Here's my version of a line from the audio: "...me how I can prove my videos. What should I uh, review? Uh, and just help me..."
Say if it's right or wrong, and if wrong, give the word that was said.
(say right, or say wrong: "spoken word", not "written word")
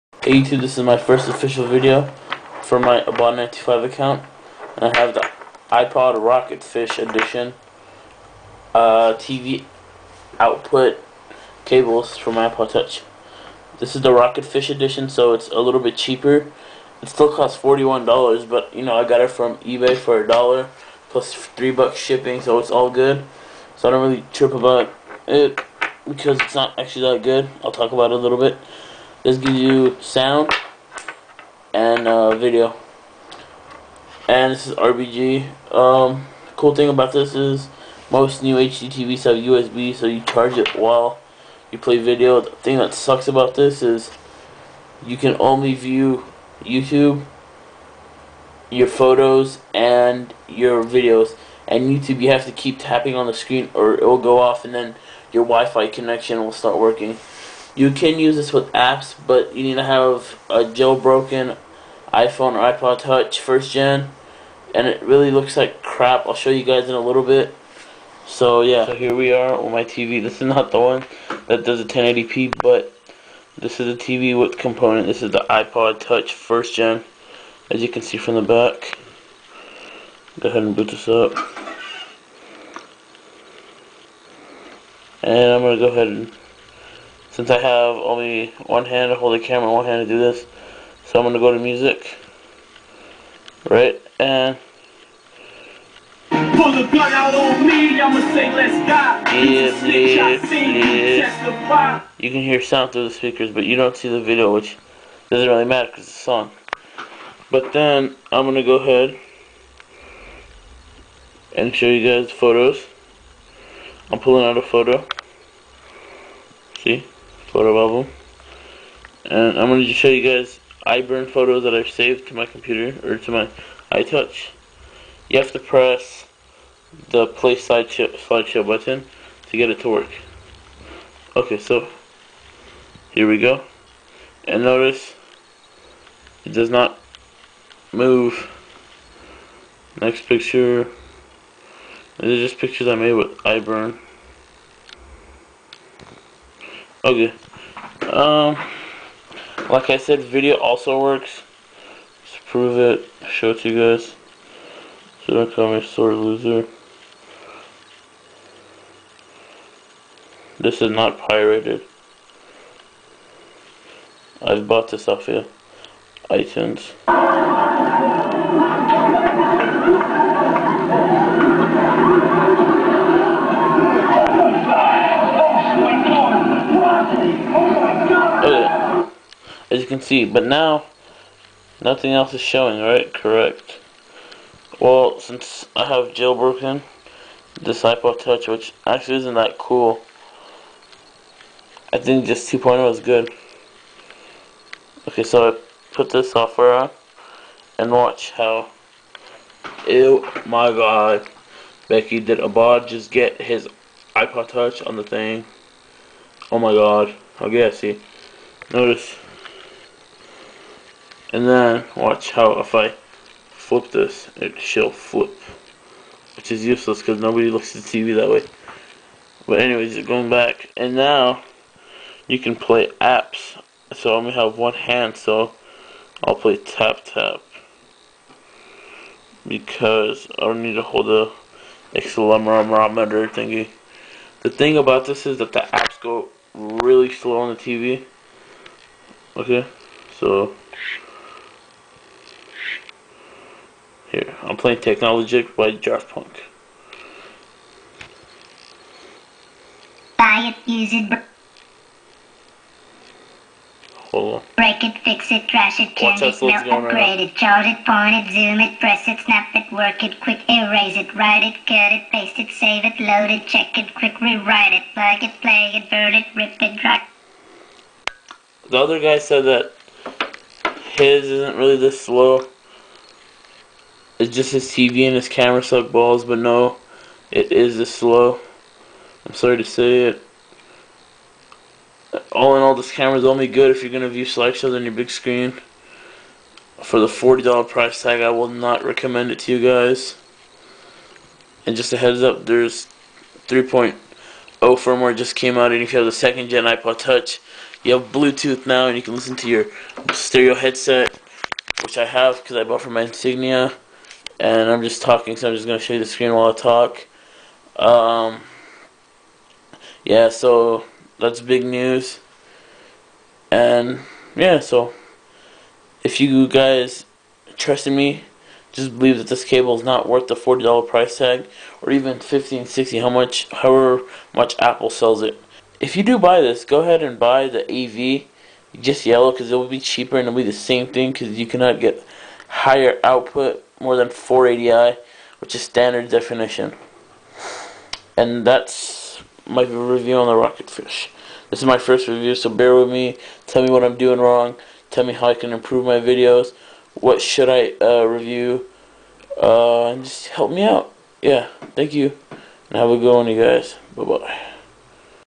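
wrong: "improve", not "prove".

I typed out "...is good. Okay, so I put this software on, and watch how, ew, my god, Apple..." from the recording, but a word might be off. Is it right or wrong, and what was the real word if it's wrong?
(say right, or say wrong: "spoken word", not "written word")
wrong: "Becky", not "Apple".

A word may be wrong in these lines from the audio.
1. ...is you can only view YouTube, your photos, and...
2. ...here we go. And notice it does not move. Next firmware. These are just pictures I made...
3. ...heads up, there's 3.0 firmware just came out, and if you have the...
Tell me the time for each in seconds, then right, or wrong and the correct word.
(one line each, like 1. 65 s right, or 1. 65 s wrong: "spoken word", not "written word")
1. 43 s right
2. 133 s wrong: "picture", not "firmware"
3. 291 s right.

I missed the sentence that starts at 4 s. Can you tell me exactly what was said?
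And I have the iPod Rocketfish Edition uh, TV output cables for my iPod Touch.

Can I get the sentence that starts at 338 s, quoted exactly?
And that's my review on the Rocketfish.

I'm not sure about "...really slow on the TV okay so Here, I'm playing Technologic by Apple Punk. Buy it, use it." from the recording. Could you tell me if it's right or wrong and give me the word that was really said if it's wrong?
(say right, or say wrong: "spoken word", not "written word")
wrong: "Daft", not "Apple".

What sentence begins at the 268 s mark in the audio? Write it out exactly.
The other guy said that his isn't really this slow.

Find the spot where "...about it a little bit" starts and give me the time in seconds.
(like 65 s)
27 s.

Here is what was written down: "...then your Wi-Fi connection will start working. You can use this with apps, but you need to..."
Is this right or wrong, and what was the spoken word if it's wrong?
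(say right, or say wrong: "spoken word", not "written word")
right.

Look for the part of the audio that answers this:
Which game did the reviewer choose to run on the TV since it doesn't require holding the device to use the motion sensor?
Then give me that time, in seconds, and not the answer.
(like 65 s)
226 s.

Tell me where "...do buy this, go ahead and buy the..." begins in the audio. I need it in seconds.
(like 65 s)
326 s.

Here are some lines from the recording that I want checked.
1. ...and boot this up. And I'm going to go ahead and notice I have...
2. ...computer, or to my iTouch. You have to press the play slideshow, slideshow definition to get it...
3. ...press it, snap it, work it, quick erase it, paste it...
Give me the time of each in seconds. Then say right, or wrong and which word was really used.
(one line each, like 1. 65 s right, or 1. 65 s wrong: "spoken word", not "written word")
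1. 80 s wrong: "since", not "notice"
2. 122 s wrong: "button", not "definition"
3. 258 s wrong: "write", not "paste".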